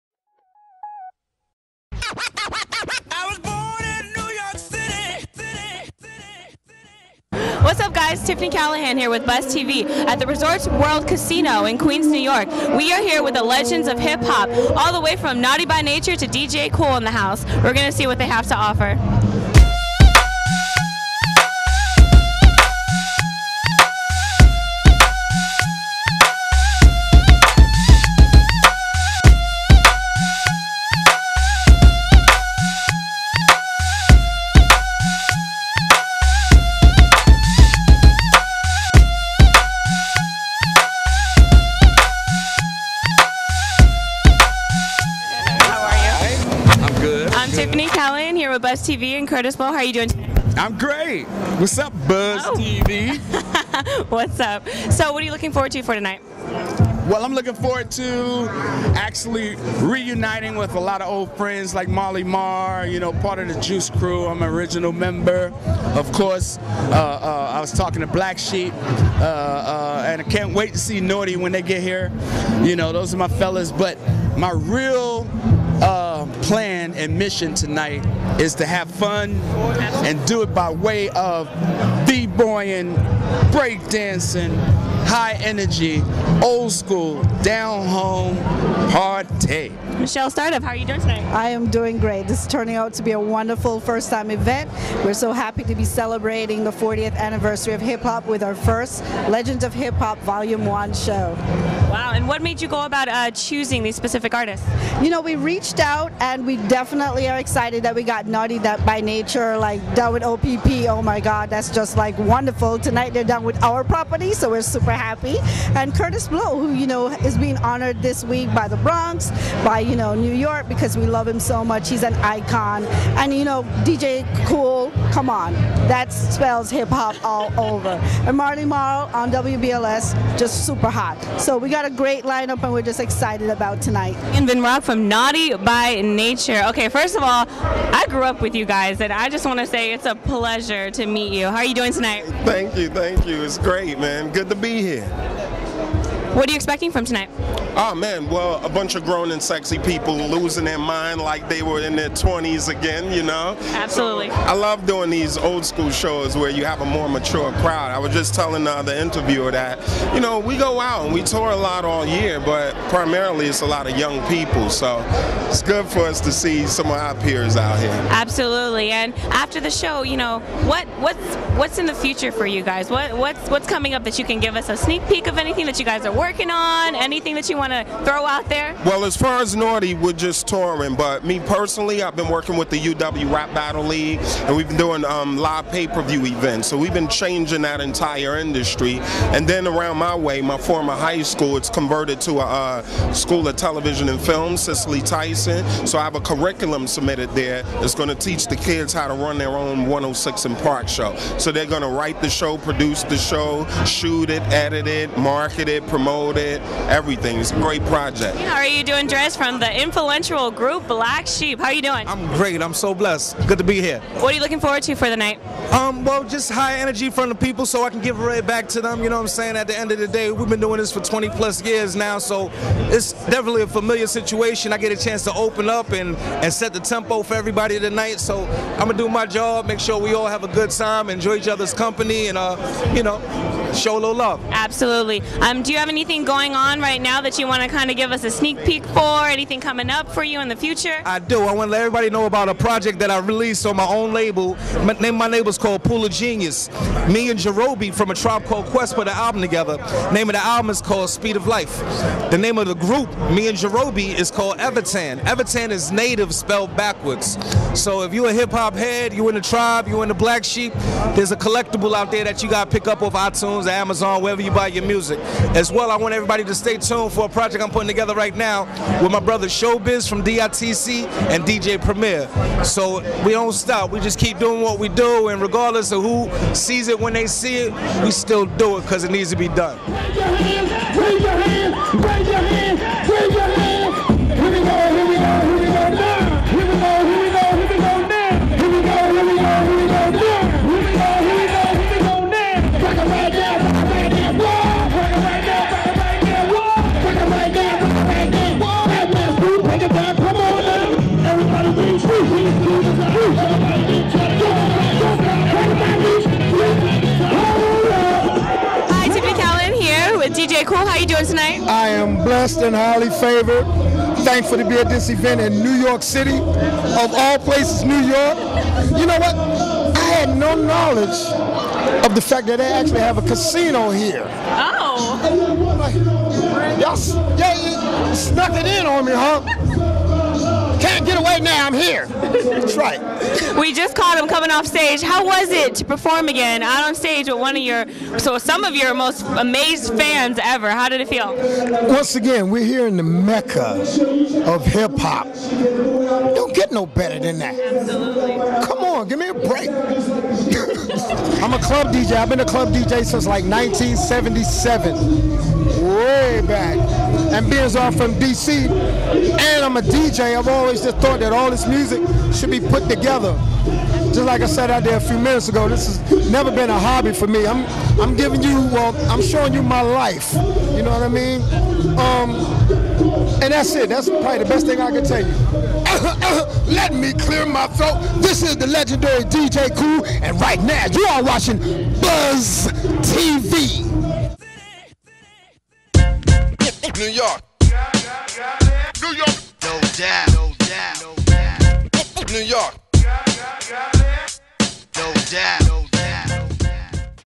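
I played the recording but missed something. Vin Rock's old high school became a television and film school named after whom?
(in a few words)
Cicely Tyson.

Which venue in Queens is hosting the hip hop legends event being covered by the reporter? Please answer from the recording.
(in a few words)
Resorts World Casino.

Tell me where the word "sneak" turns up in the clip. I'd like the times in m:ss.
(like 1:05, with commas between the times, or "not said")
2:54, 3:58.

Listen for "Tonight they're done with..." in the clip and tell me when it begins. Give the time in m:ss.
1:52.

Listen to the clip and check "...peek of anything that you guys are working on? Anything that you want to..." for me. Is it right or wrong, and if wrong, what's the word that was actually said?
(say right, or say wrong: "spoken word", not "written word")
right.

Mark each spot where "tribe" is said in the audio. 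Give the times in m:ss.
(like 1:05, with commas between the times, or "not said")
4:08, 4:19.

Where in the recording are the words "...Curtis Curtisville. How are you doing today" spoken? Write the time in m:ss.
0:49.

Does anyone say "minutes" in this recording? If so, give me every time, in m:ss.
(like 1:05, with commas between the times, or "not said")
6:05.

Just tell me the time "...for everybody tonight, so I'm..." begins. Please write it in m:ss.
3:47.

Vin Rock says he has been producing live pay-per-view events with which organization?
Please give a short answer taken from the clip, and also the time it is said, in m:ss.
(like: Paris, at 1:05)
UW Rap Battle League, at 3:02.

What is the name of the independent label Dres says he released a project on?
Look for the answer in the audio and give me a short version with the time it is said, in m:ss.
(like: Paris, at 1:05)
Pool of Genius, at 4:05.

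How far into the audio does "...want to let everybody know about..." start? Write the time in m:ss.
4:01.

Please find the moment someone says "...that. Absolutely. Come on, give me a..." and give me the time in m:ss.
5:47.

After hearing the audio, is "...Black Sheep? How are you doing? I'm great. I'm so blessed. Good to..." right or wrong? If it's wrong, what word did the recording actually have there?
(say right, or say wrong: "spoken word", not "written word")
right.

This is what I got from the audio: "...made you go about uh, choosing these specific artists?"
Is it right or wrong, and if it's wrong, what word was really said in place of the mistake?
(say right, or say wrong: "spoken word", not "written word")
right.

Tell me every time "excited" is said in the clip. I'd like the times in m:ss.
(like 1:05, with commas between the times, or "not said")
1:47, 2:13.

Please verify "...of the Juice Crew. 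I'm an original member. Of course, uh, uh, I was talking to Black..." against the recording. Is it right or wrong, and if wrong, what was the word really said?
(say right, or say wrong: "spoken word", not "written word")
right.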